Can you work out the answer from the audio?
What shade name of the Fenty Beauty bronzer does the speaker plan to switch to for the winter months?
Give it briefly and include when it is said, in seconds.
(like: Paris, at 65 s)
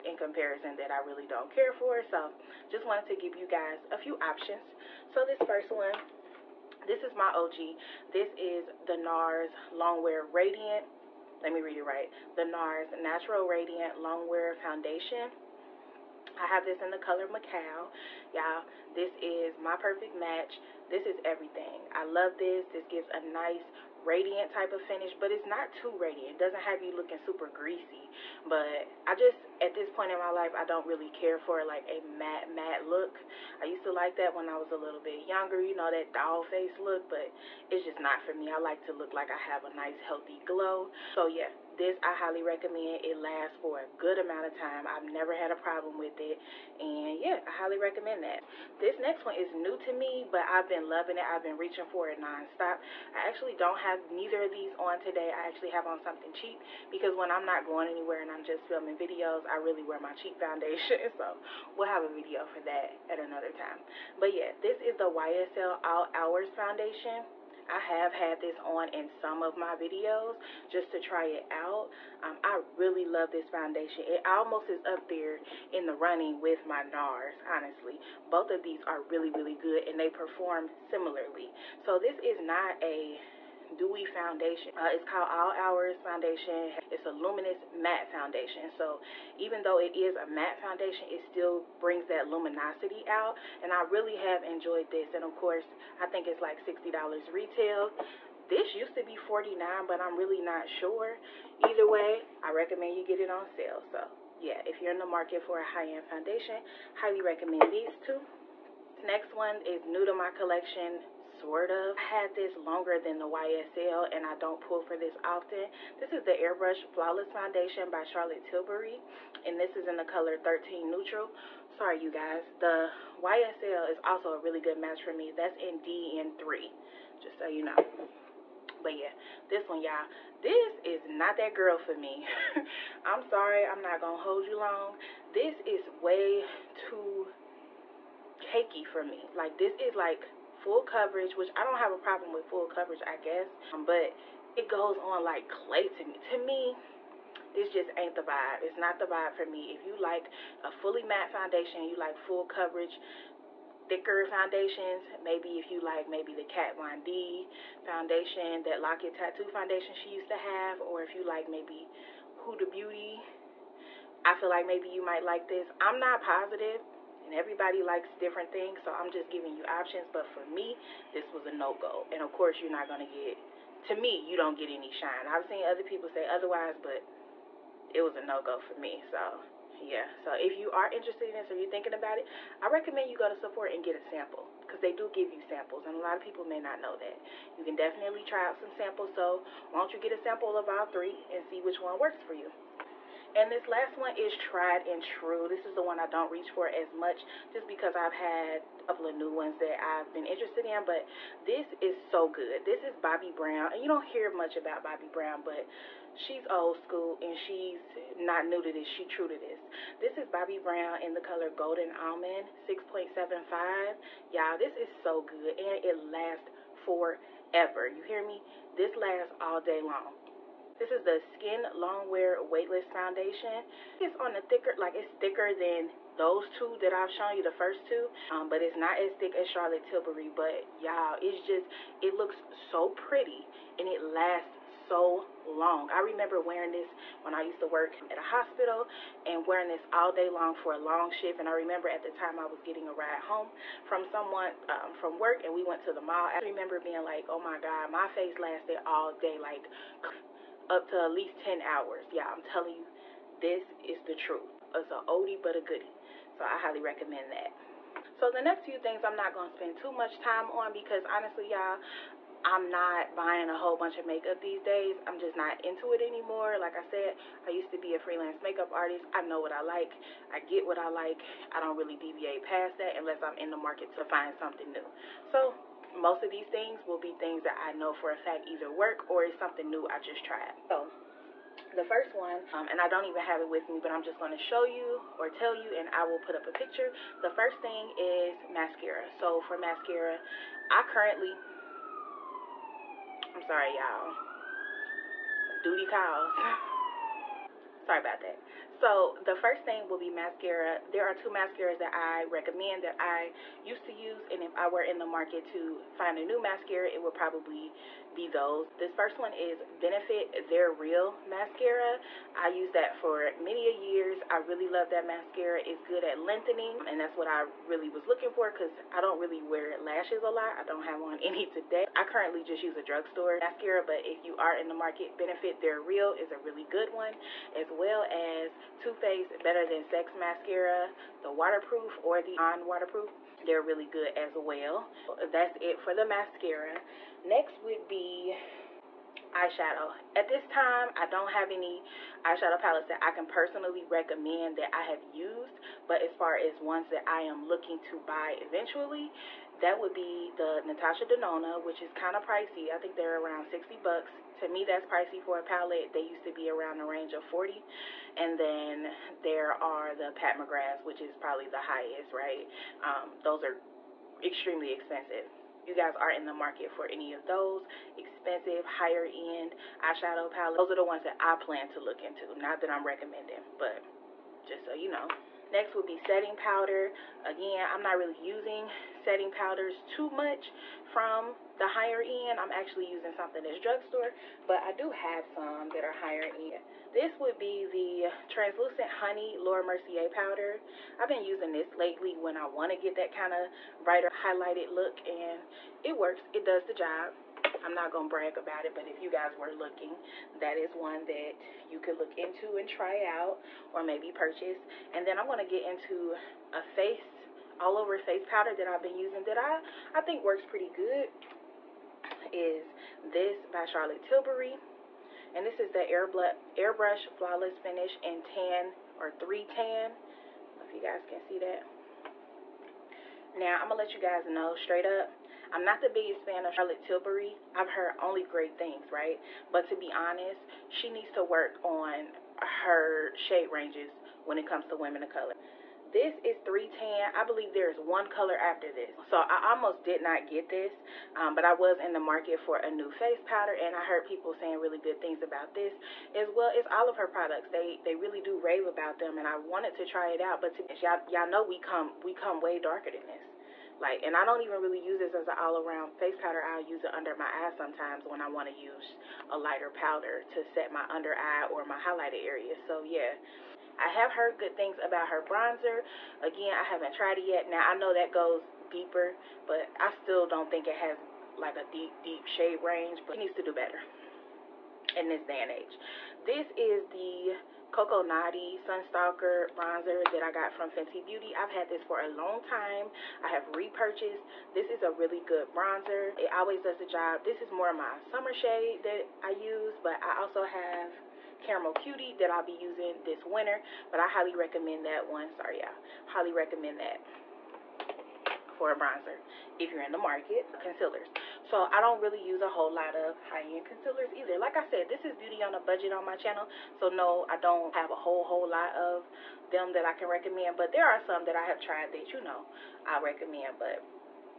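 Caramel Cutie, at 491 s.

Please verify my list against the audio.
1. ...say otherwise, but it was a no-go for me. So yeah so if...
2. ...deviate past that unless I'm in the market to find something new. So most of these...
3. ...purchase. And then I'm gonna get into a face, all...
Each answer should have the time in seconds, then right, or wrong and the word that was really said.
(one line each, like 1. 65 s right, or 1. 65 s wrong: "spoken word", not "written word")
1. 176 s right
2. 271 s right
3. 404 s right.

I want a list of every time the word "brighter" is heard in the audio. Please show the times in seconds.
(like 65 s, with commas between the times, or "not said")
393 s.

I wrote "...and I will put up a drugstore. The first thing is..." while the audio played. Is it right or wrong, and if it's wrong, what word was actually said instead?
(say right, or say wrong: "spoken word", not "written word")
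wrong: "picture", not "drugstore".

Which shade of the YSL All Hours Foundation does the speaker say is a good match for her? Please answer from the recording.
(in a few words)
DN3.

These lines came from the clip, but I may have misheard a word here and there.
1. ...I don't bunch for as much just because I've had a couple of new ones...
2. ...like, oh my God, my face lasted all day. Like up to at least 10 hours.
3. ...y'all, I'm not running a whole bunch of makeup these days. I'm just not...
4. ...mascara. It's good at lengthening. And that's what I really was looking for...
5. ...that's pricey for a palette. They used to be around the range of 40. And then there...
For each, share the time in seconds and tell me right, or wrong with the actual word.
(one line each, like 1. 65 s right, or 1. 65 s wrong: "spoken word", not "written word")
1. 195 s wrong: "reach", not "bunch"
2. 247 s right
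3. 261 s wrong: "buying", not "running"
4. 315 s right
5. 354 s right.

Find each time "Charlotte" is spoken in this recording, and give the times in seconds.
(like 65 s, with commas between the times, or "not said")
118 s, 229 s, 413 s, 426 s.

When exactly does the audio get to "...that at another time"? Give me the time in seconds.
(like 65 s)
62 s.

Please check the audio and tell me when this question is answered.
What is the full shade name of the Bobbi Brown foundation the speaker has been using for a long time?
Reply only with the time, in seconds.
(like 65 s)
211 s.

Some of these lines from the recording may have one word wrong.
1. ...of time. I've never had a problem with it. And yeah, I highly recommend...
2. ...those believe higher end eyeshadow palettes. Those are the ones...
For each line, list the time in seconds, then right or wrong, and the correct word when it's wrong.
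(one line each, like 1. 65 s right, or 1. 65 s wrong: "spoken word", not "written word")
1. 44 s right
2. 367 s wrong: "expensive", not "believe".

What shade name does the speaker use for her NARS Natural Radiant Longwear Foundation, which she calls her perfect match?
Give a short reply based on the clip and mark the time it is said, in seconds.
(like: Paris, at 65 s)
Macao, at 17 s.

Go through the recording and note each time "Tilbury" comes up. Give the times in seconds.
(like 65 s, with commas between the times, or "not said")
118 s, 229 s, 414 s, 426 s.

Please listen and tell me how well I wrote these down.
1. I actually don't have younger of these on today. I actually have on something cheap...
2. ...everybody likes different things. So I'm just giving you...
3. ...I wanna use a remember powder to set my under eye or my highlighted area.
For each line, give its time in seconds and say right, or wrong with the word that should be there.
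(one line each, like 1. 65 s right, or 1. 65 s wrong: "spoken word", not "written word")
1. 53 s wrong: "neither", not "younger"
2. 167 s right
3. 458 s wrong: "lighter", not "remember".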